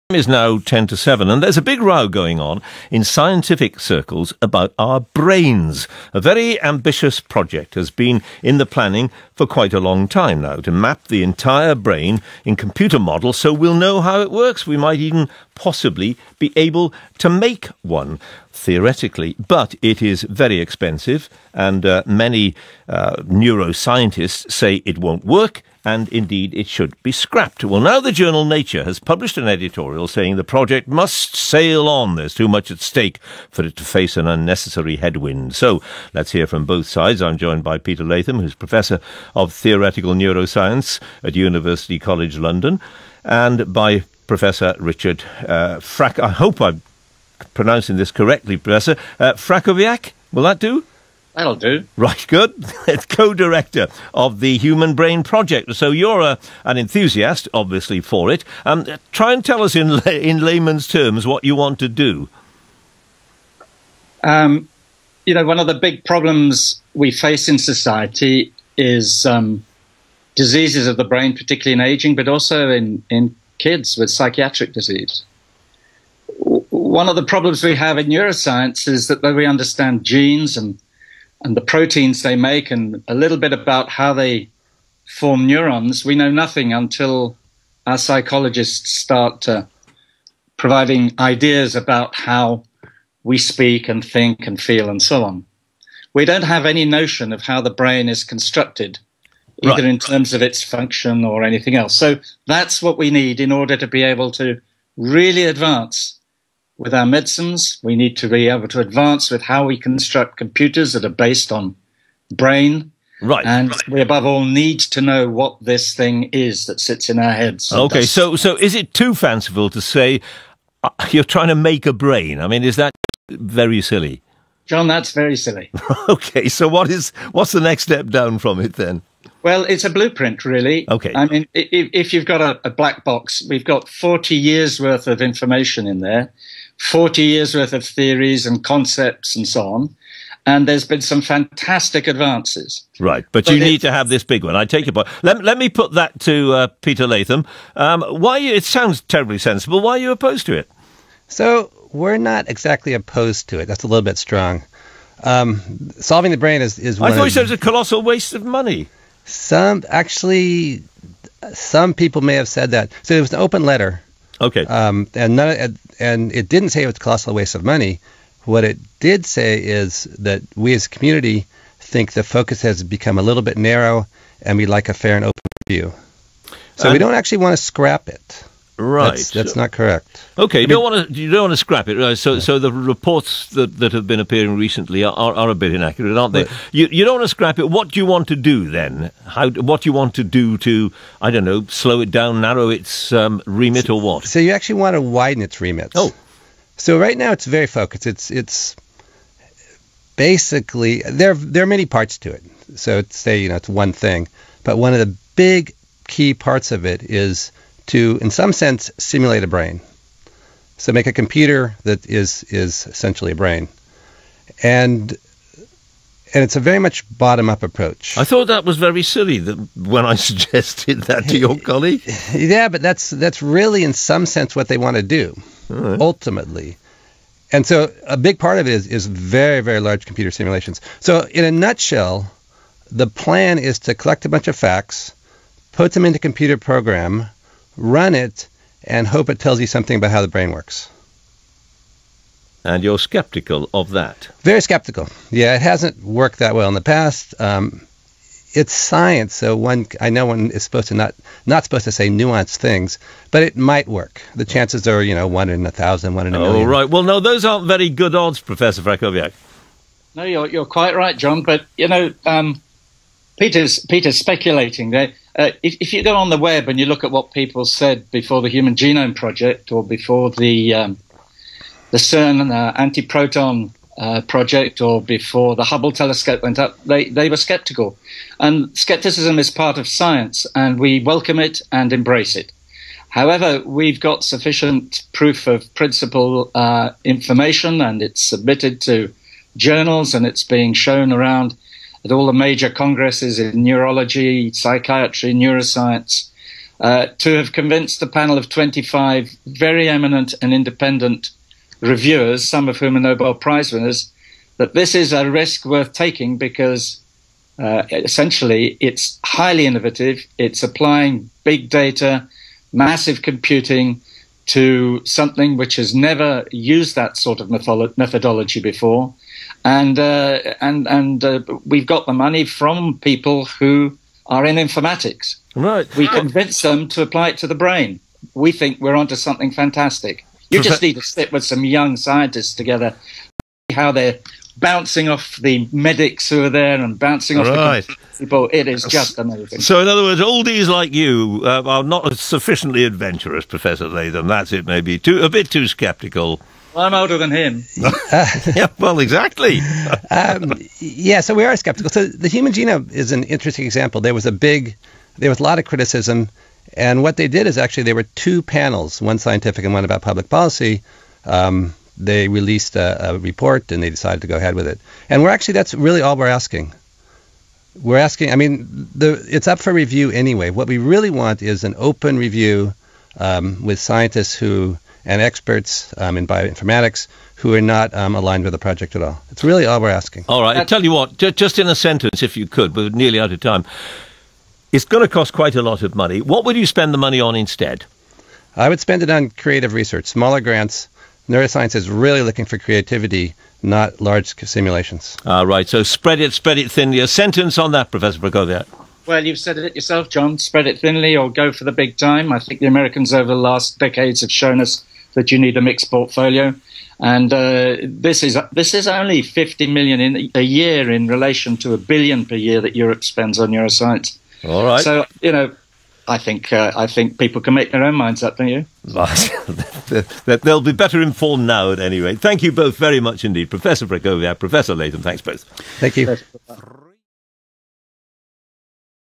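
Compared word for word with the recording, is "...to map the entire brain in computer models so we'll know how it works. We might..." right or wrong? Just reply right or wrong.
right.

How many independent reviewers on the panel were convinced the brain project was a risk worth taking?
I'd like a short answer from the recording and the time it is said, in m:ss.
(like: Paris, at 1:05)
25, at 4:58.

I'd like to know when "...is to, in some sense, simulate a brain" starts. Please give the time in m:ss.
3:27.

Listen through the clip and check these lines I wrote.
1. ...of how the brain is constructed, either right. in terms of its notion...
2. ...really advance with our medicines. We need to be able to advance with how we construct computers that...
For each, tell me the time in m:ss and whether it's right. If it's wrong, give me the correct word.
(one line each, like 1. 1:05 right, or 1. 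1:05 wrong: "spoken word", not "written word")
1. 1:37 wrong: "function", not "notion"
2. 1:44 right.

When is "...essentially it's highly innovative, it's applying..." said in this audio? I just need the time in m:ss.
5:07.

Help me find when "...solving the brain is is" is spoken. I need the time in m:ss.
2:35.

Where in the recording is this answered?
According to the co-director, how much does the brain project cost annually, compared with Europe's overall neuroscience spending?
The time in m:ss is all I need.
6:49.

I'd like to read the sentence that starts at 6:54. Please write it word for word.
So you know, I think uh, I think people can make their own minds up, don't you?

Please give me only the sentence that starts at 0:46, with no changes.
I hope I'm pronouncing this correctly, Professor.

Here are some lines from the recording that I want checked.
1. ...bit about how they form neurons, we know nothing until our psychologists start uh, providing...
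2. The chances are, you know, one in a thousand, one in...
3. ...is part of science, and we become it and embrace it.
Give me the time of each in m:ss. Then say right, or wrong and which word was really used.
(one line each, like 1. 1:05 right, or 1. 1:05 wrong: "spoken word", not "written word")
1. 1:23 right
2. 4:14 right
3. 4:39 wrong: "welcome", not "become".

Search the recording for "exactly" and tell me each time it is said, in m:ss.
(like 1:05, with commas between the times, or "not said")
2:32, 5:48.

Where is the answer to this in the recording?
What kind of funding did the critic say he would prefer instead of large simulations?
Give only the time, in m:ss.
6:30.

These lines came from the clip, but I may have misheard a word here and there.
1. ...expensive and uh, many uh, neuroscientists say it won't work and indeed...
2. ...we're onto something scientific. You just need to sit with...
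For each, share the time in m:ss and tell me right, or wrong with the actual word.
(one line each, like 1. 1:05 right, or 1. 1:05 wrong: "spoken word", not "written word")
1. 0:20 right
2. 5:28 wrong: "fantastic", not "scientific".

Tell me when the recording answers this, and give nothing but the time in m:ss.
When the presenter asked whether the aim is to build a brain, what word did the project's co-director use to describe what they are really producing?
2:09.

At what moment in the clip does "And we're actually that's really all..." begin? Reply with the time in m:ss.
6:05.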